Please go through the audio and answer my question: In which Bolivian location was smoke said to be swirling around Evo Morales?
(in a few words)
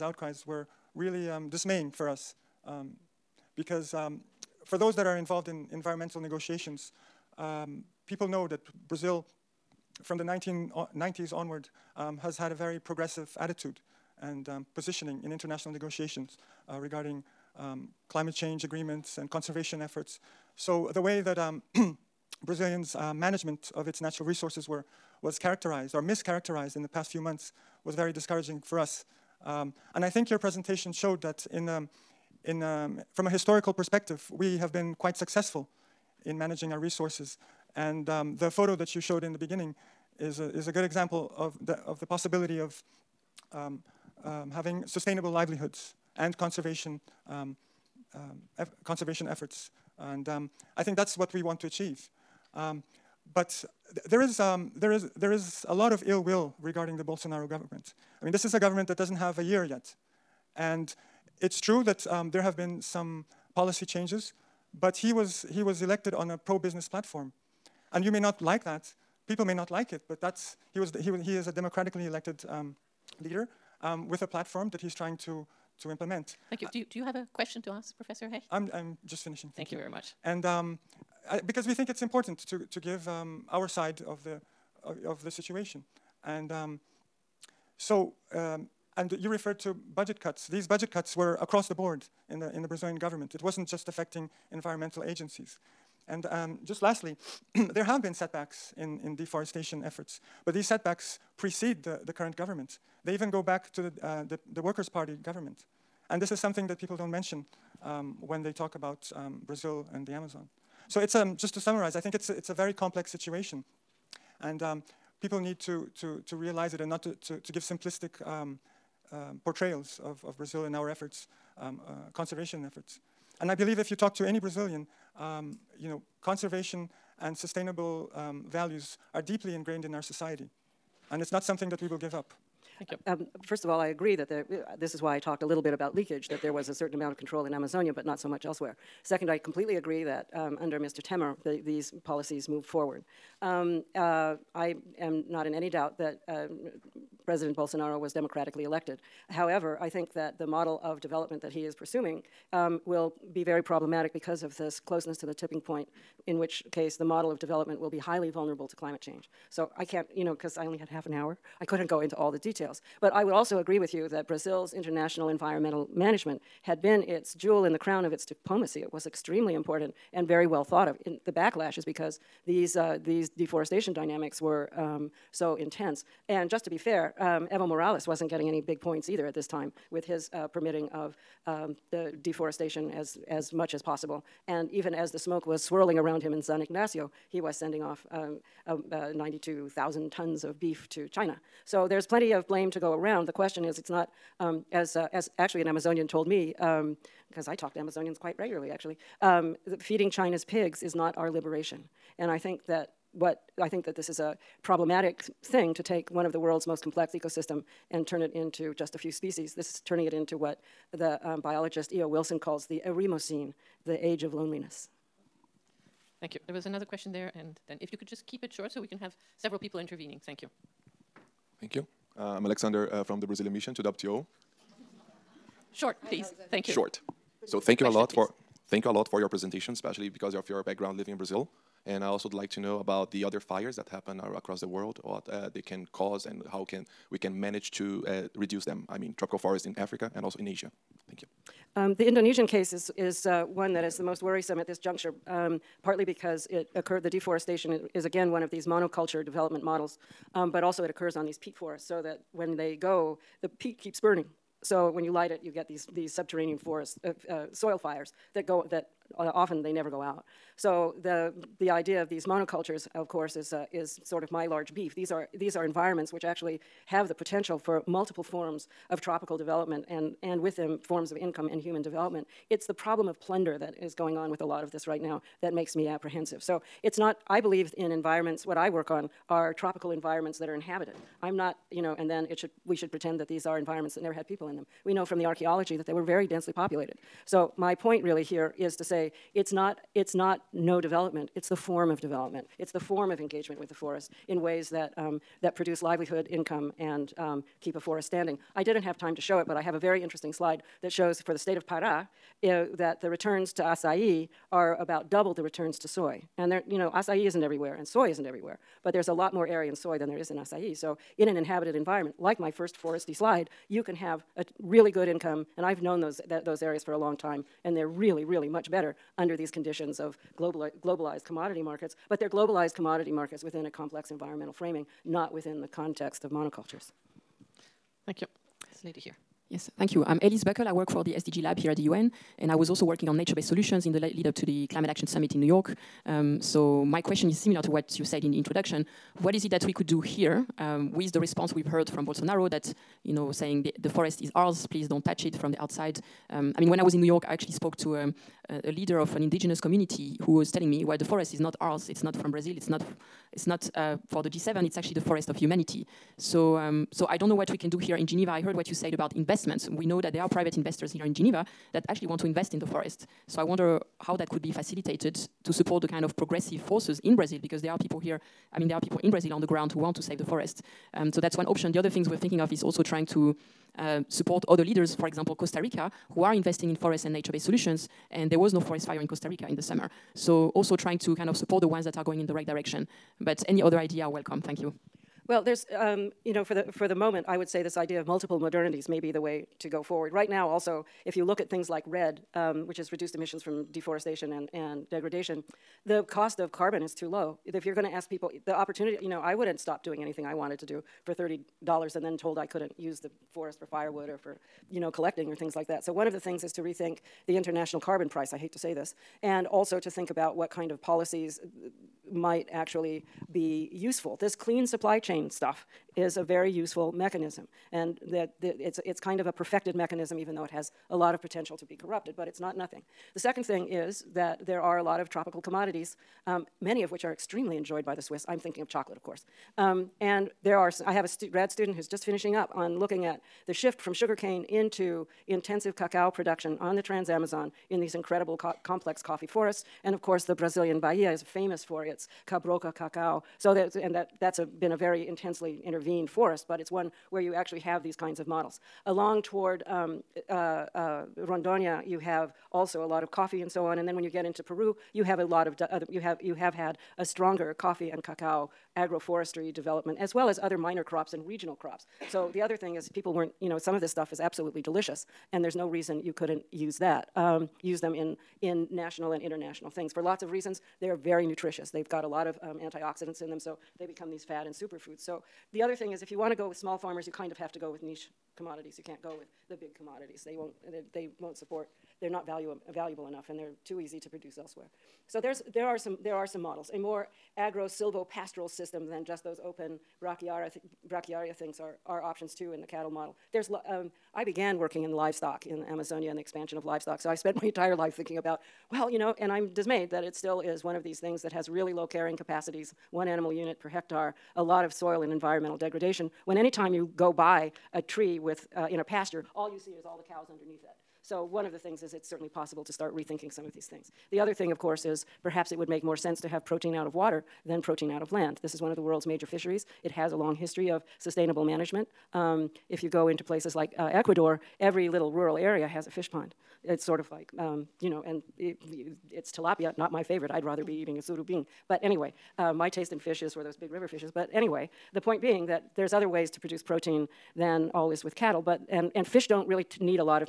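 San Ignacio.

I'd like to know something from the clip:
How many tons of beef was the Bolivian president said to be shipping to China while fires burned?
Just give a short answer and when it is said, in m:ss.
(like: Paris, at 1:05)
92,000 tons, at 3:09.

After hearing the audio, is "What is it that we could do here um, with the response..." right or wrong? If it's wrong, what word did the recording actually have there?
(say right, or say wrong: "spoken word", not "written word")
right.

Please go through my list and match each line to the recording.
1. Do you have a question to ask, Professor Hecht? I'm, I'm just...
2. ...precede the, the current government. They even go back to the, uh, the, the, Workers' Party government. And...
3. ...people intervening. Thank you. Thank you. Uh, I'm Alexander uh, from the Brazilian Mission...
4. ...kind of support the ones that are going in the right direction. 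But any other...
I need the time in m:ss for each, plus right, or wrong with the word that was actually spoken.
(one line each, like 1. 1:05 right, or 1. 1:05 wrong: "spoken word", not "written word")
1. 1:16 right
2. 1:41 right
3. 3:39 right
4. 6:21 right.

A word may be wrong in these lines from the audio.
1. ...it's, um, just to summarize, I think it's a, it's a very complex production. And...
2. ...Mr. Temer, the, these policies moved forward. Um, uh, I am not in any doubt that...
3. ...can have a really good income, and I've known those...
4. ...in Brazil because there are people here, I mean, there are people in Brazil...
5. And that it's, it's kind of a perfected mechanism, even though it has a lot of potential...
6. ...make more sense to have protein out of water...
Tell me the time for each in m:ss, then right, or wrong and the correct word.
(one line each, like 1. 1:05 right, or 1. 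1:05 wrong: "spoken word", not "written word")
1. 1:50 wrong: "situation", not "production"
2. 2:20 right
3. 5:13 right
4. 6:07 right
5. 6:57 right
6. 8:35 right.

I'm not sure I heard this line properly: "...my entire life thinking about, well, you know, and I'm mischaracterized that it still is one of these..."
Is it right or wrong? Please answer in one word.
wrong.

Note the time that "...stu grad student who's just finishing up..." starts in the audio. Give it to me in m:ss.
7:11.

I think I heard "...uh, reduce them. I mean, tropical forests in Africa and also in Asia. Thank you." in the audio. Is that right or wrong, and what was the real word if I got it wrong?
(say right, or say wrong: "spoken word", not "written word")
right.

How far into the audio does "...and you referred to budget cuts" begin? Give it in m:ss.
1:28.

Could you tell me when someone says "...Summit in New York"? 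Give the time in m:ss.
5:35.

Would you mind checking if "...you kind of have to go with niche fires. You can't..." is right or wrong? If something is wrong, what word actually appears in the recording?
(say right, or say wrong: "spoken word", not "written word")
wrong: "commodities", not "fires".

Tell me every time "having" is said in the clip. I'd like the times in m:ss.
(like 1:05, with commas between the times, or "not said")
0:44.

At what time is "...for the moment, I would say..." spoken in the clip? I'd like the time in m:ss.
6:26.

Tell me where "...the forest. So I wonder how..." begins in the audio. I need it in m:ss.
6:02.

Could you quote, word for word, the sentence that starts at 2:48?
It was extremely important and very well thought of.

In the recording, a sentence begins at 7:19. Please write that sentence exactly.
And of course, the Brazilian Bahia is famous for its cabruca cacao.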